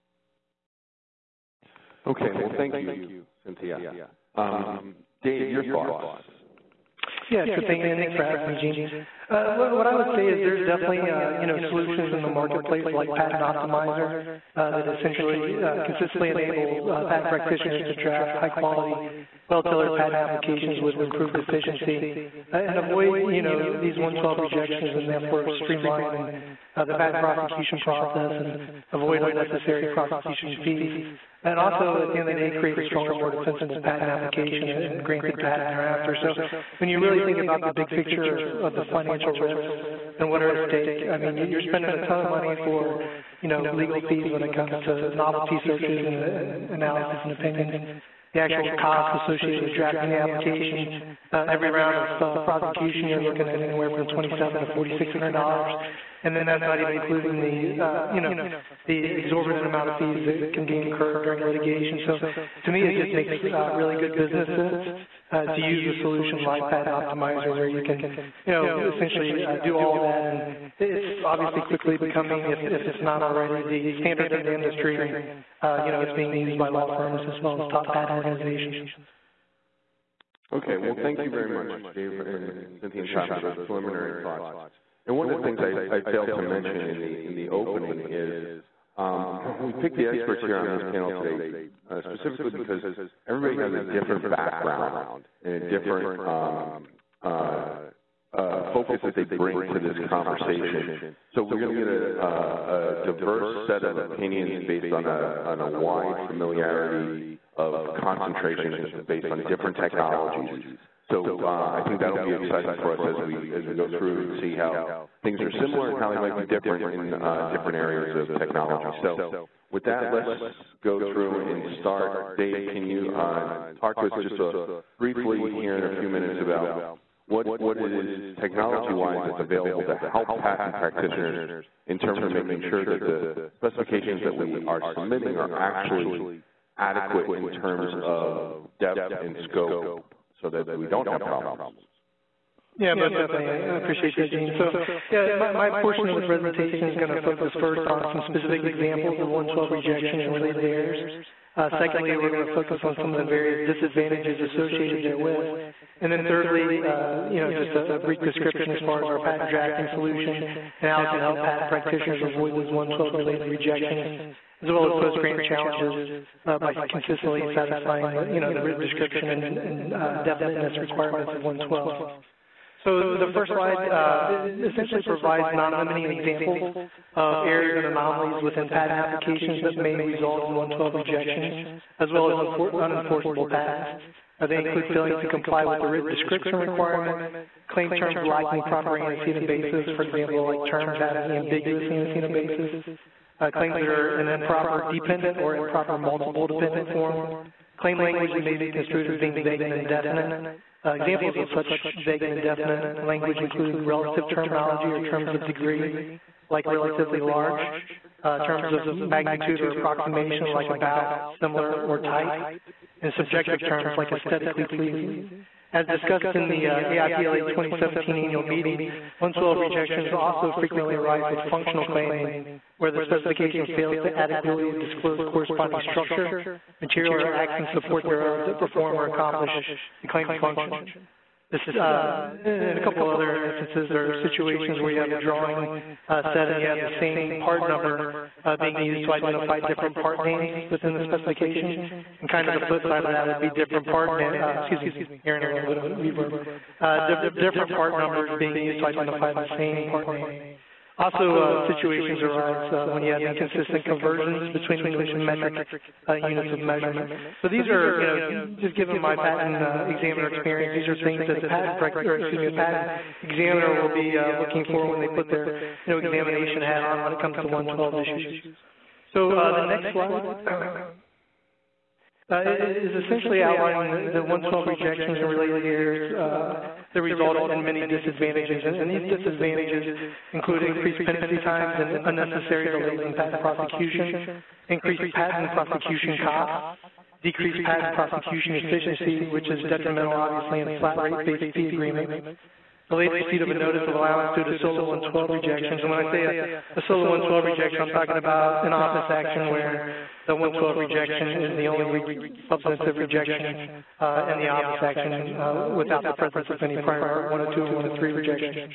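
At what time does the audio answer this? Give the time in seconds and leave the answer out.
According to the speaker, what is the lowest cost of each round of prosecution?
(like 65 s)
54 s.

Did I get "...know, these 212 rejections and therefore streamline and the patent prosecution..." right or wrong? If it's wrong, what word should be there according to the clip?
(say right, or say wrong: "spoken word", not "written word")
wrong: "112", not "212".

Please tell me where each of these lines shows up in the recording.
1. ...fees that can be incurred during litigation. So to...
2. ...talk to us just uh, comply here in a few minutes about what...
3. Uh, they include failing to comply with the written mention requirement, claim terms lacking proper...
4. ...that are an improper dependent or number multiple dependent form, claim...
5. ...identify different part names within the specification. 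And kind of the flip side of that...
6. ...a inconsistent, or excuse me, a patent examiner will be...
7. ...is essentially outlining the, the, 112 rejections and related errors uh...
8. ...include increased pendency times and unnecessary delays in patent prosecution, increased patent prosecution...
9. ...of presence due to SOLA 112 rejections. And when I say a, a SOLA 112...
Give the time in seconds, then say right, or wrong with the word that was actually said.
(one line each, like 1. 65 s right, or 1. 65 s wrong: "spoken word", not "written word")
1. 59 s right
2. 123 s wrong: "briefly", not "comply"
3. 184 s wrong: "description", not "mention"
4. 193 s wrong: "improper", not "number"
5. 239 s right
6. 261 s wrong: "patent", not "inconsistent"
7. 272 s right
8. 280 s right
9. 293 s wrong: "allowance", not "presence".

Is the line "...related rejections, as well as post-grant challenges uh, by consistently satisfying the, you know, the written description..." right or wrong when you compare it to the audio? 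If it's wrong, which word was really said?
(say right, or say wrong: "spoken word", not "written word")
right.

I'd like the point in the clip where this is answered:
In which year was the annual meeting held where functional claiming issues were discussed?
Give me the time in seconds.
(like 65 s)
217 s.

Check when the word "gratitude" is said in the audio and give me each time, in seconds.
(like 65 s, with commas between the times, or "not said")
not said.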